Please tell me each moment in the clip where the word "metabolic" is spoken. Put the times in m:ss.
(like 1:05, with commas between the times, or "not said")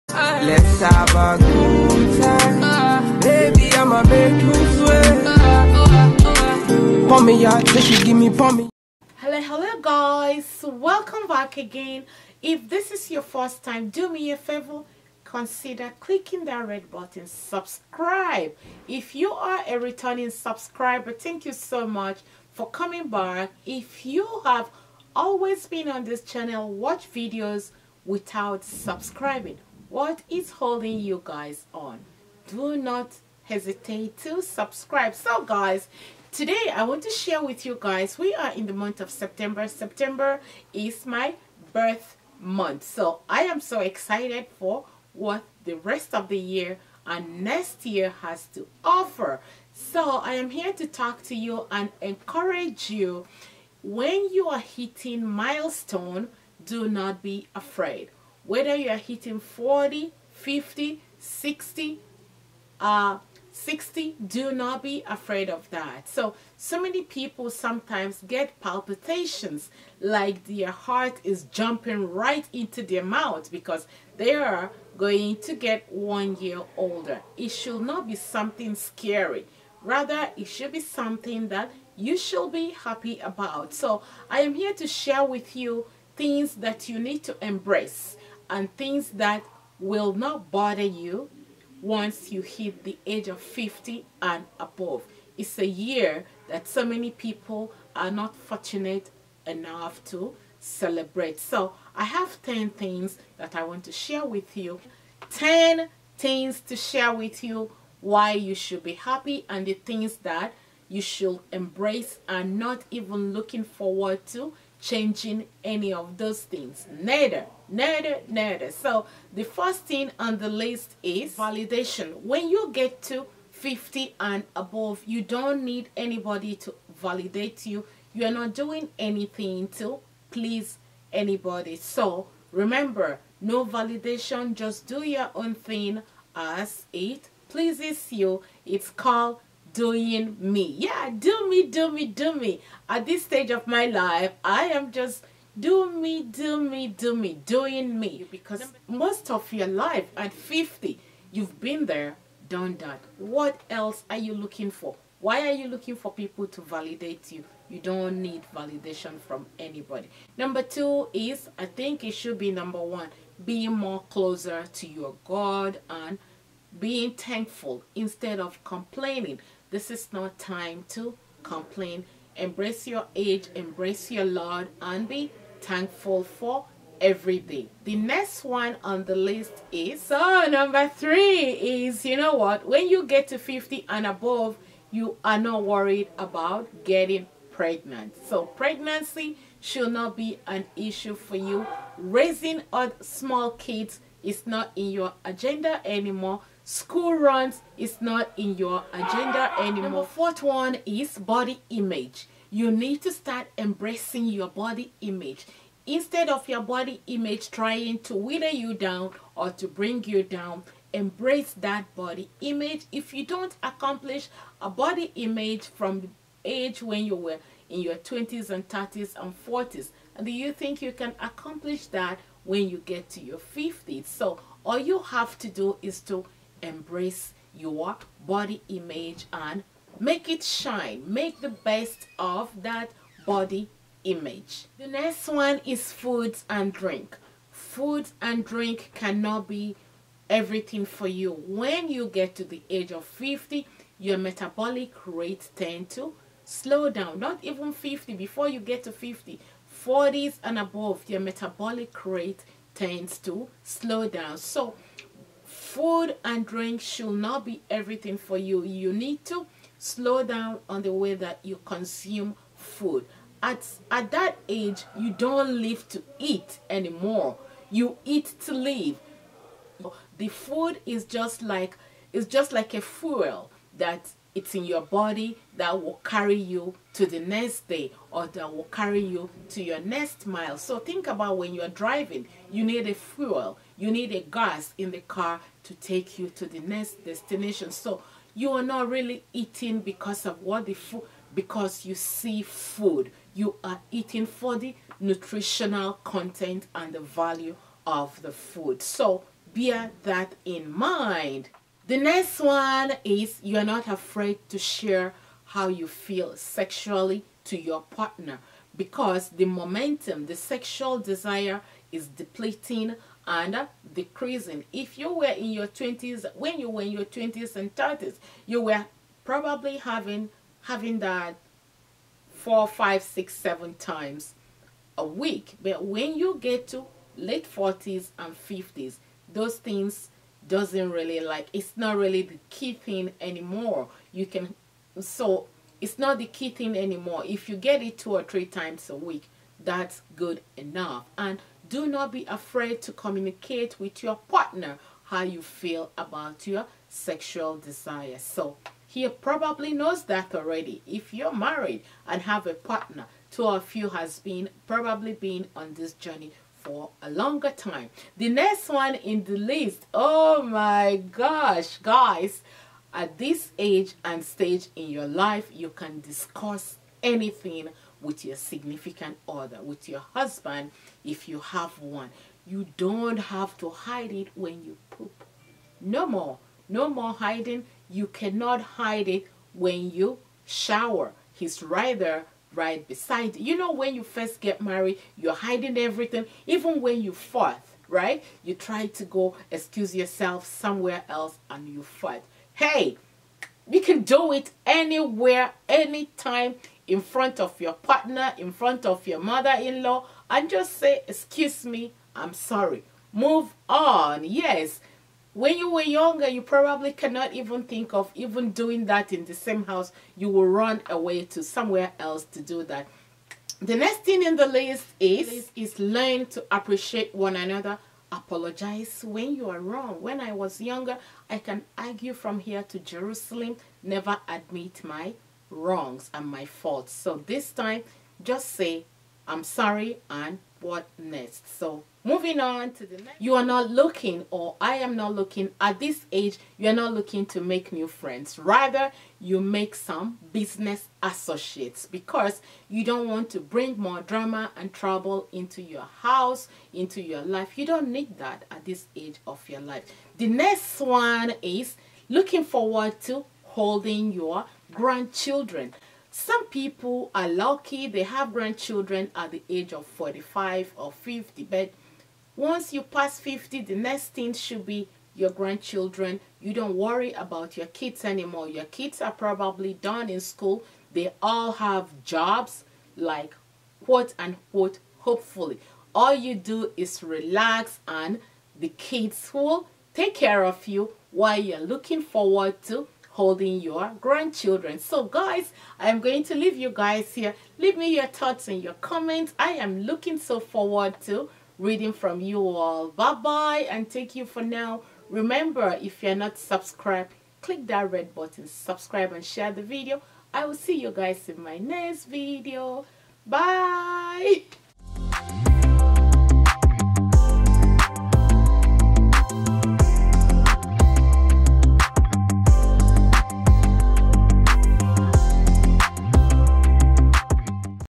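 4:04, 4:11.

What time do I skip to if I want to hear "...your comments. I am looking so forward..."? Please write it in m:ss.
8:08.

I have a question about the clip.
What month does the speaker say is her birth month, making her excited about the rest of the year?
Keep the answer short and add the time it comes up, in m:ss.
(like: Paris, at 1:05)
September, at 0:39.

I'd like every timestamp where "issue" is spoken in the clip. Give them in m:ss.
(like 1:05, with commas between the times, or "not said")
3:10.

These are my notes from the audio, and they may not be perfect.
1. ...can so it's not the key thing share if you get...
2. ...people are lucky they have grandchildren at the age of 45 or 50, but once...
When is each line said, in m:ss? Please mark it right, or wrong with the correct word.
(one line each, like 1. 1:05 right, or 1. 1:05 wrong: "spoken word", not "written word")
1. 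5:34 wrong: "anymore", not "share"
2. 7:36 right.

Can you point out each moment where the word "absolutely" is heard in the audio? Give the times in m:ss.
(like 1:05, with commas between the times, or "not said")
not said.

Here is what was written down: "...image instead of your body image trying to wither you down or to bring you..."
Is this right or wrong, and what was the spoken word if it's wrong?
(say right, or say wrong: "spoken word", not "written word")
right.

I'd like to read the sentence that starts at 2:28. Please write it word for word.
Because most of your life at 50, you've been there, done that.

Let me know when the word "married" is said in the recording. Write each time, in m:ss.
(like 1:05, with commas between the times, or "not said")
5:51, 6:24.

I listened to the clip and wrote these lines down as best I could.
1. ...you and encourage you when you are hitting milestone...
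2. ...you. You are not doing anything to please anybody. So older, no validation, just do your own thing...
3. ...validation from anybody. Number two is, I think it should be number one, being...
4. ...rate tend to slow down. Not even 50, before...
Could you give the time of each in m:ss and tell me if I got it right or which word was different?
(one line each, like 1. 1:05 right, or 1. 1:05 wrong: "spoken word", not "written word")
1. 0:51 right
2. 2:07 wrong: "remember", not "older"
3. 2:38 right
4. 4:05 right.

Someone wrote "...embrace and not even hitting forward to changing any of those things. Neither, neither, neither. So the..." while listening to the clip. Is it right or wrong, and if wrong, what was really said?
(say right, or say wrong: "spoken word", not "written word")
wrong: "looking", not "hitting".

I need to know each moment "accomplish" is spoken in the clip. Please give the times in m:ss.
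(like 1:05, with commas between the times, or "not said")
3:33, 3:41.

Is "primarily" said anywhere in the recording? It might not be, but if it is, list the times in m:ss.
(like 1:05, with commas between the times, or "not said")
not said.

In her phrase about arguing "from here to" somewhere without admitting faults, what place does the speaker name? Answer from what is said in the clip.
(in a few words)
Jerusalem.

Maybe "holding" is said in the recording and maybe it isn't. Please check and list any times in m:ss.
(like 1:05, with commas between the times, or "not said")
0:30, 7:33, 8:03.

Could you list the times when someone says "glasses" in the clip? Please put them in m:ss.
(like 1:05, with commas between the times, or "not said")
not said.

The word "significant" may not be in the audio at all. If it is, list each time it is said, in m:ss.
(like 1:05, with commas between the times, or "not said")
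6:08.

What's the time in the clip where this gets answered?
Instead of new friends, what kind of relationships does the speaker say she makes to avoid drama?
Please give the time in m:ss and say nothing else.
7:20.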